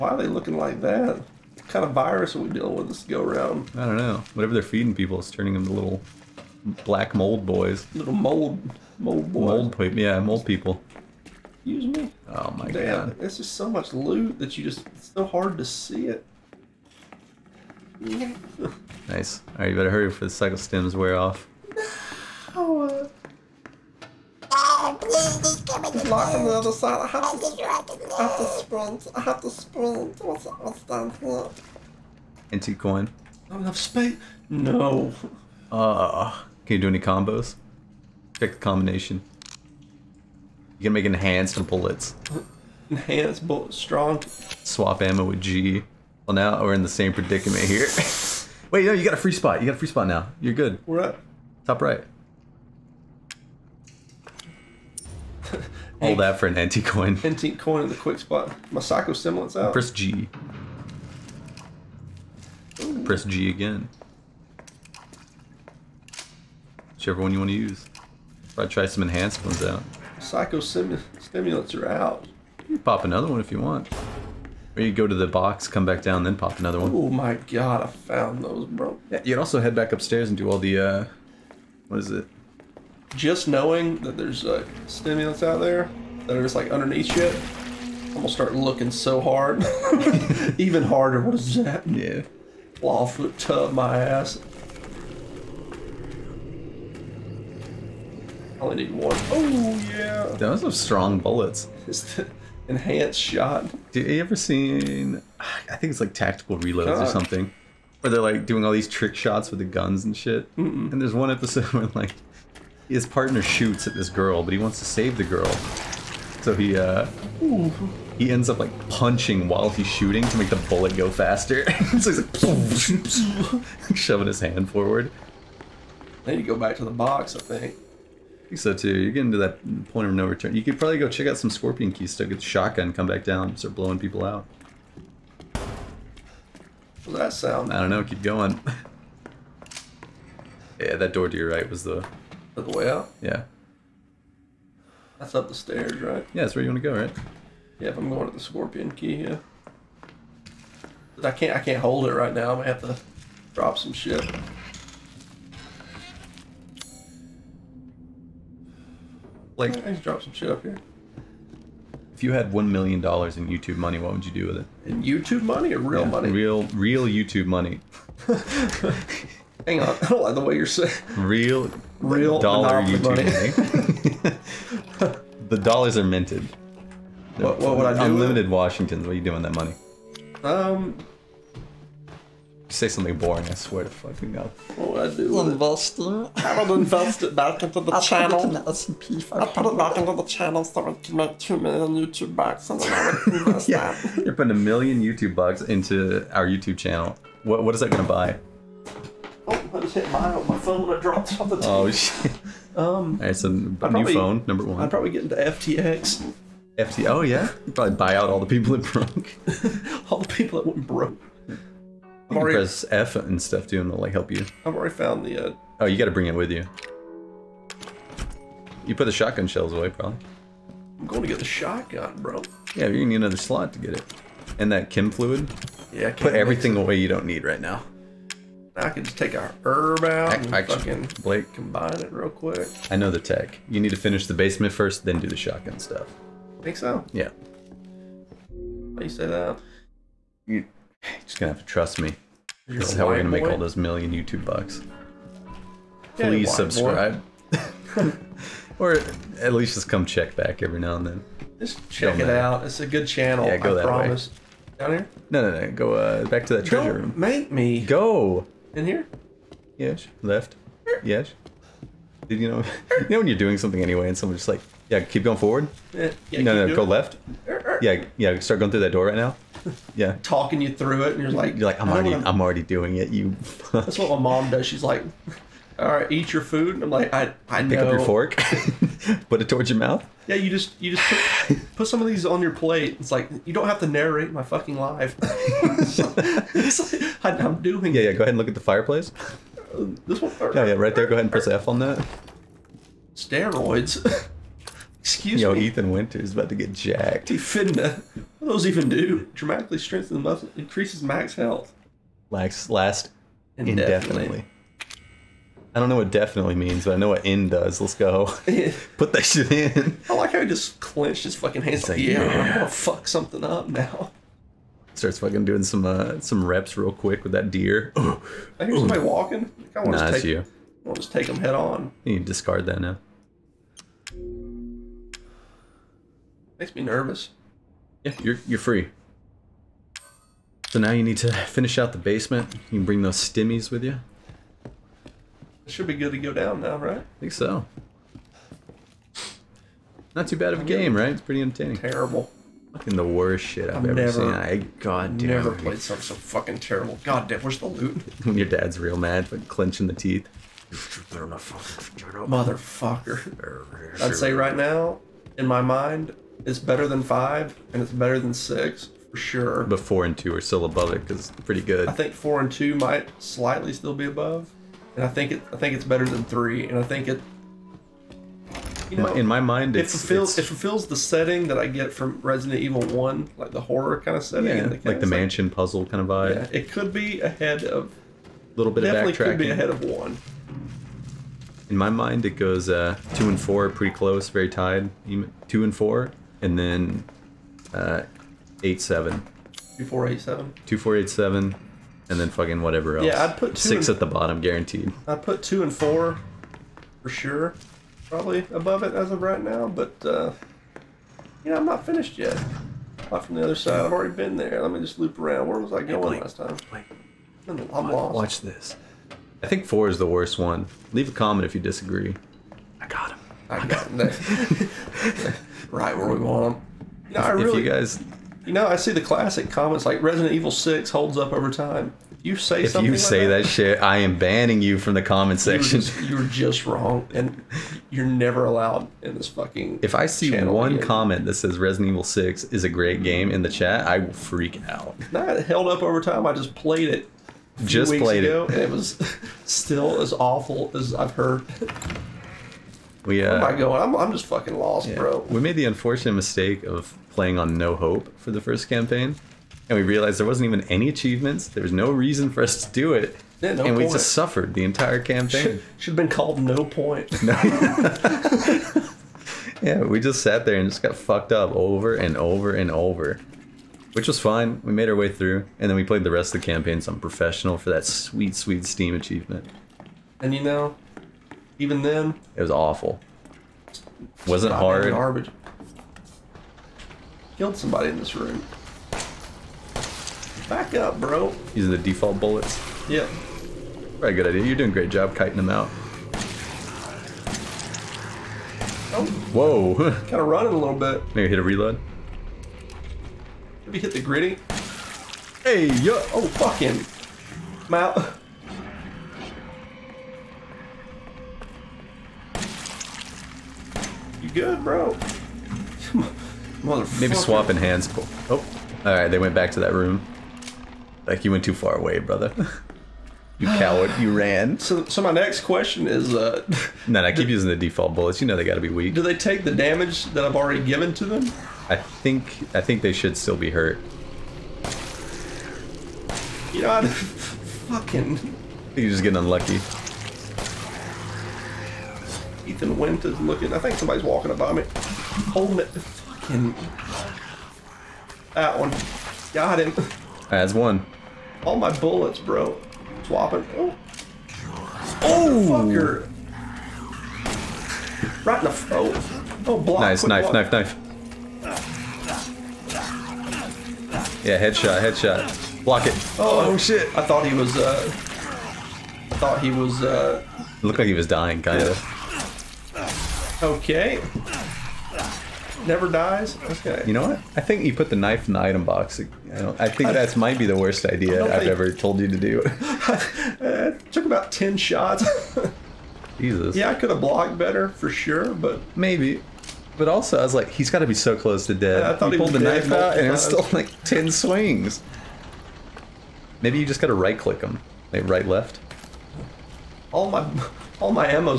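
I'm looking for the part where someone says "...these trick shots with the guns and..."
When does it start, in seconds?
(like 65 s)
108 s.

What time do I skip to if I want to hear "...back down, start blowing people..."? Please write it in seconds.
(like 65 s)
133 s.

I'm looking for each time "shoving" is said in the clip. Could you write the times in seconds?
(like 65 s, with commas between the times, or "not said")
123 s.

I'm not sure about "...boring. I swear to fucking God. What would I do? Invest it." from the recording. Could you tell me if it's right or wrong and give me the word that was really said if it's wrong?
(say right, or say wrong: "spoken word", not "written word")
right.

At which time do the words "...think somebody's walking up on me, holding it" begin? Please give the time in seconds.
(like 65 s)
533 s.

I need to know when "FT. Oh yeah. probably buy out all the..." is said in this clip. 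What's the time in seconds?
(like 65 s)
206 s.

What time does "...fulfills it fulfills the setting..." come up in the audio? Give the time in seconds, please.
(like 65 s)
369 s.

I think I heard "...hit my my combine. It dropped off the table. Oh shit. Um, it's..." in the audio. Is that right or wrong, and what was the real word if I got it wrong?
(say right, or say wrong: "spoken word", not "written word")
wrong: "phone", not "combine".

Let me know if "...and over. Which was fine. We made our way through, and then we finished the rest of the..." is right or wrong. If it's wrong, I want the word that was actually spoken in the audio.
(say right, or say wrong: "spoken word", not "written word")
wrong: "played", not "finished".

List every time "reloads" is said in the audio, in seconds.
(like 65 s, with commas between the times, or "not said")
106 s, 491 s.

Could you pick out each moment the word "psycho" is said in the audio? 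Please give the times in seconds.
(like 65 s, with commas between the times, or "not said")
20 s, 70 s.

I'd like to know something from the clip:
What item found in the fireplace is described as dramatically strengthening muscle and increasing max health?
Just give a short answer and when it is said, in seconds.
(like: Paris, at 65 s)
Steroids, at 293 s.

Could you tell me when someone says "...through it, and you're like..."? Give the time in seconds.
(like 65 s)
270 s.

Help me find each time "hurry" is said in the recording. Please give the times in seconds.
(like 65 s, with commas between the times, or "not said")
19 s.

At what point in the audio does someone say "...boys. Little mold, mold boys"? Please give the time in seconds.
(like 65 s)
7 s.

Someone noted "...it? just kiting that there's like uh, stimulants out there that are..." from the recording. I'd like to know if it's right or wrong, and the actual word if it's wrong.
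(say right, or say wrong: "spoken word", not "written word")
wrong: "knowing", not "kiting".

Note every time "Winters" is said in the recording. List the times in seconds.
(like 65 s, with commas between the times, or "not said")
295 s.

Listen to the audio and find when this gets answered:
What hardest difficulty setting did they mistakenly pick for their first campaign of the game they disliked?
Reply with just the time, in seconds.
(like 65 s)
447 s.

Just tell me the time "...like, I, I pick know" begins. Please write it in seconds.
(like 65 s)
276 s.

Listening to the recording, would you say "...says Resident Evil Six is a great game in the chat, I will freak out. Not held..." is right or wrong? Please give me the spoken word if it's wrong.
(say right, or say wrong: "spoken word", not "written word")
right.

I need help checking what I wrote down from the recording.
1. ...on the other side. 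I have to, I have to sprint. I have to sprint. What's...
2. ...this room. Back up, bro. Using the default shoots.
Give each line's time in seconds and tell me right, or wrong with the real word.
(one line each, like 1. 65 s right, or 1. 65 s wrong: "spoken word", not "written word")
1. 26 s right
2. 477 s wrong: "bullets", not "shoots".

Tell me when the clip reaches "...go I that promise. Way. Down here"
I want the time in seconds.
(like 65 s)
253 s.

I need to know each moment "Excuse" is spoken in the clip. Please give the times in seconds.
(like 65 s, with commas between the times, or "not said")
11 s, 294 s.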